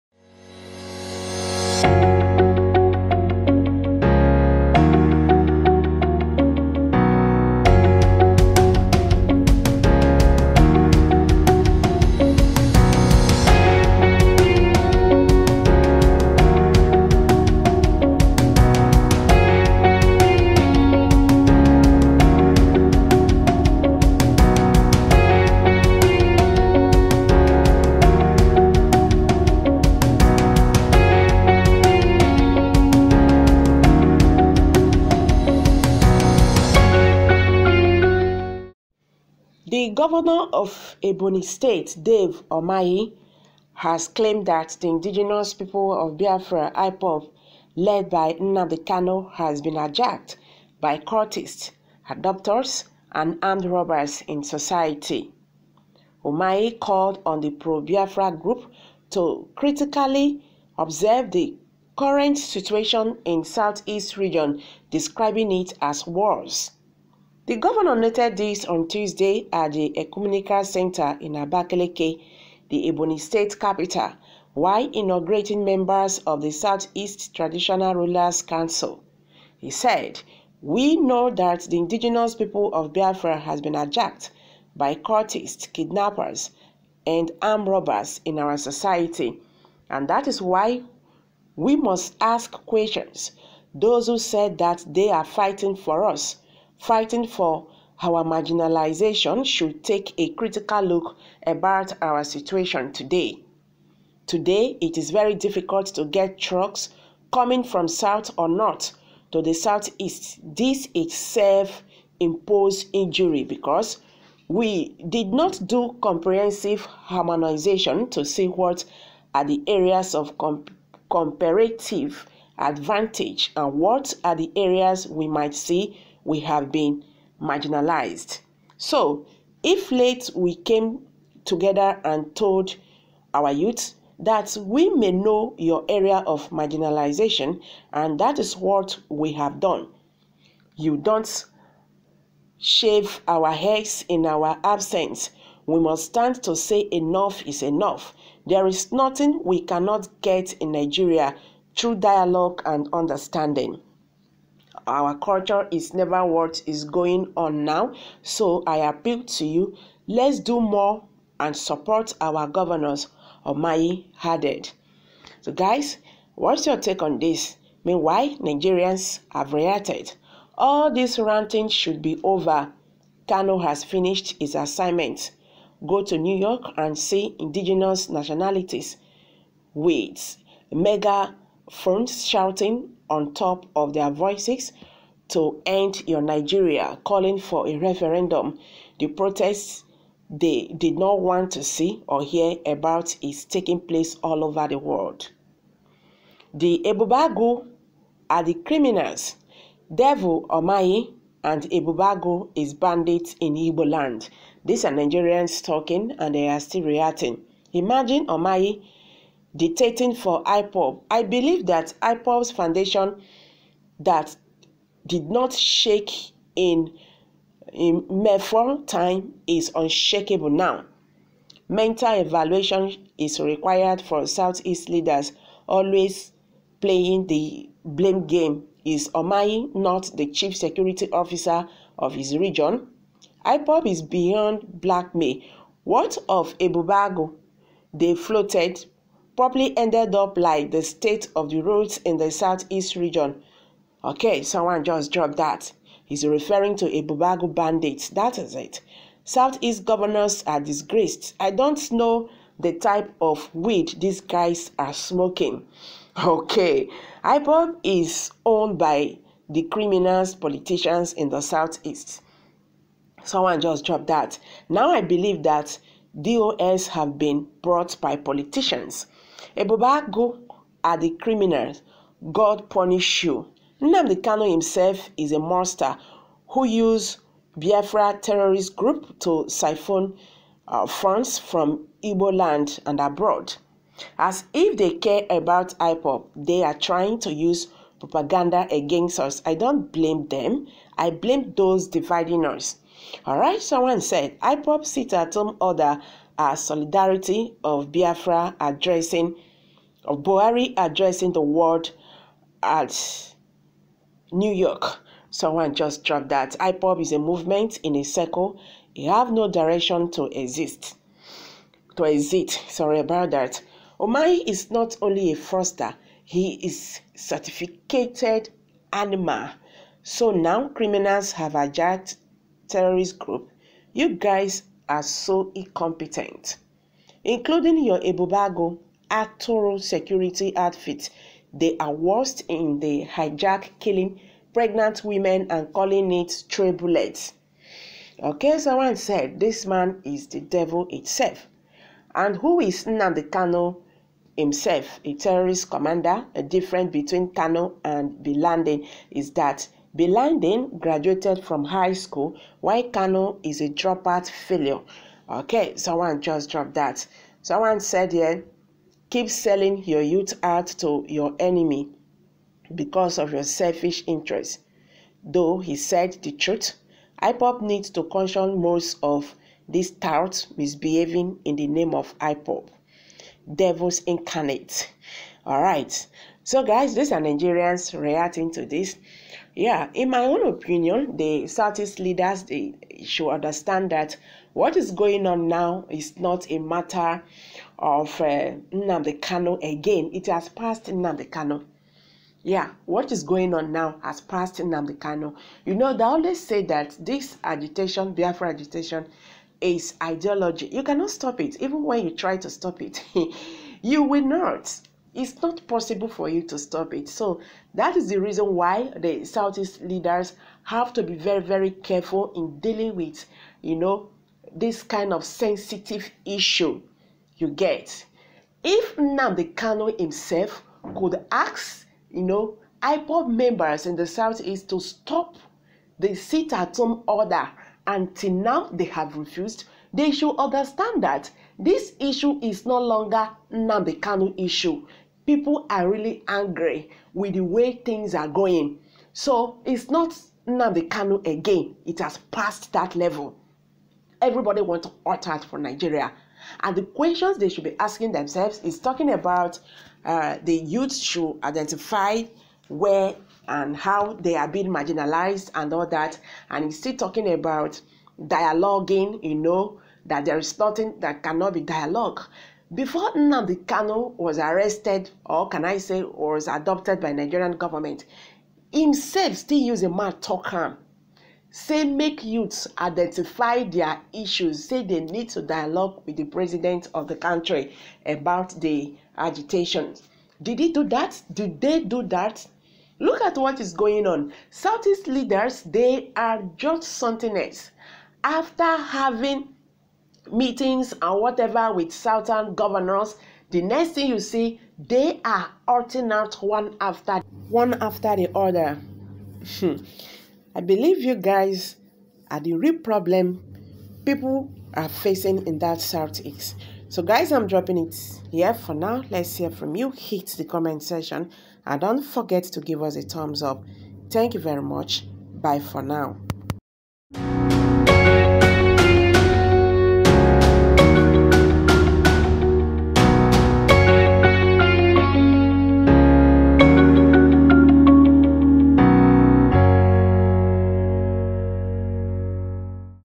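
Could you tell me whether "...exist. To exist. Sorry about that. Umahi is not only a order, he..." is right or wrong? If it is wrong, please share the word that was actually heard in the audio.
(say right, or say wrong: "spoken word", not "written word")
wrong: "froster", not "order".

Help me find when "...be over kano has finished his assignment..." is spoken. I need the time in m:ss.
2:52.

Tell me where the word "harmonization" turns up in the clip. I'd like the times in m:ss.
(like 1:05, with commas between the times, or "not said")
1:56.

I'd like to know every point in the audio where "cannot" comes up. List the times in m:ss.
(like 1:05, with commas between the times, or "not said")
2:29, 6:40, 7:41.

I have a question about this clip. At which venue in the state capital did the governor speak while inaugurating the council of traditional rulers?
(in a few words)
Ecumenical Center.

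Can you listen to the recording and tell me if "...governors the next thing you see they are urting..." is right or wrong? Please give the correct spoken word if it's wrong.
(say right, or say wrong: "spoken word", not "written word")
right.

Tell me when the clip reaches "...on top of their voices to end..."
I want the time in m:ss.
3:03.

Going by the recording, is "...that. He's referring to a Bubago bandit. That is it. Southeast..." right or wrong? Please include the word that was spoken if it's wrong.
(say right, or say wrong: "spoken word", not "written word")
right.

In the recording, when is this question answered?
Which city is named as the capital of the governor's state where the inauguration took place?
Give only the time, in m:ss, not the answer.
1:11.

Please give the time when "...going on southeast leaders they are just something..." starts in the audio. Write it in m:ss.
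8:03.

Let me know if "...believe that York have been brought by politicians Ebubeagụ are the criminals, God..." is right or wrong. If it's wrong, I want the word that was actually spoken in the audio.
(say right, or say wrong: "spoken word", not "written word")
wrong: "DOS", not "York".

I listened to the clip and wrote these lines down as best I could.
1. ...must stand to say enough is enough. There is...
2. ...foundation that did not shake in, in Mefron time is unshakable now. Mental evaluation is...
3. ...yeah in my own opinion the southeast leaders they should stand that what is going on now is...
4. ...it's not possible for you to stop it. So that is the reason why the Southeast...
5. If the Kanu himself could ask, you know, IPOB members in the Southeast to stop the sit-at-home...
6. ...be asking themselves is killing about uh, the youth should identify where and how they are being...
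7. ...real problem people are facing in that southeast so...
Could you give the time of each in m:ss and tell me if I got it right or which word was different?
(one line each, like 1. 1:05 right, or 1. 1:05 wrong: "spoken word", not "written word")
1. 2:25 right
2. 3:32 right
3. 6:19 wrong: "understand", not "stand"
4. 6:45 right
5. 6:58 right
6. 7:27 wrong: "talking", not "killing"
7. 8:22 right.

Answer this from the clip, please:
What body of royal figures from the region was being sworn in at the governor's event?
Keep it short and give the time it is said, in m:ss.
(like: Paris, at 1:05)
Southeast Traditional Rulers Council, at 1:16.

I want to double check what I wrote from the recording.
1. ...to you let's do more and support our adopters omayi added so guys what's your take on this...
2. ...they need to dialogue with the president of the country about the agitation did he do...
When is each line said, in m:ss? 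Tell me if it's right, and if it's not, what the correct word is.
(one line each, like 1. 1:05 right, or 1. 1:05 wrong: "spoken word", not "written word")
1. 2:39 wrong: "governors", not "adopters"
2. 7:54 right.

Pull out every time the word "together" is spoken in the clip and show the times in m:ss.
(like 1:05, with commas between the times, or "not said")
2:11.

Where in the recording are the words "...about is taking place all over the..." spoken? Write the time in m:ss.
3:12.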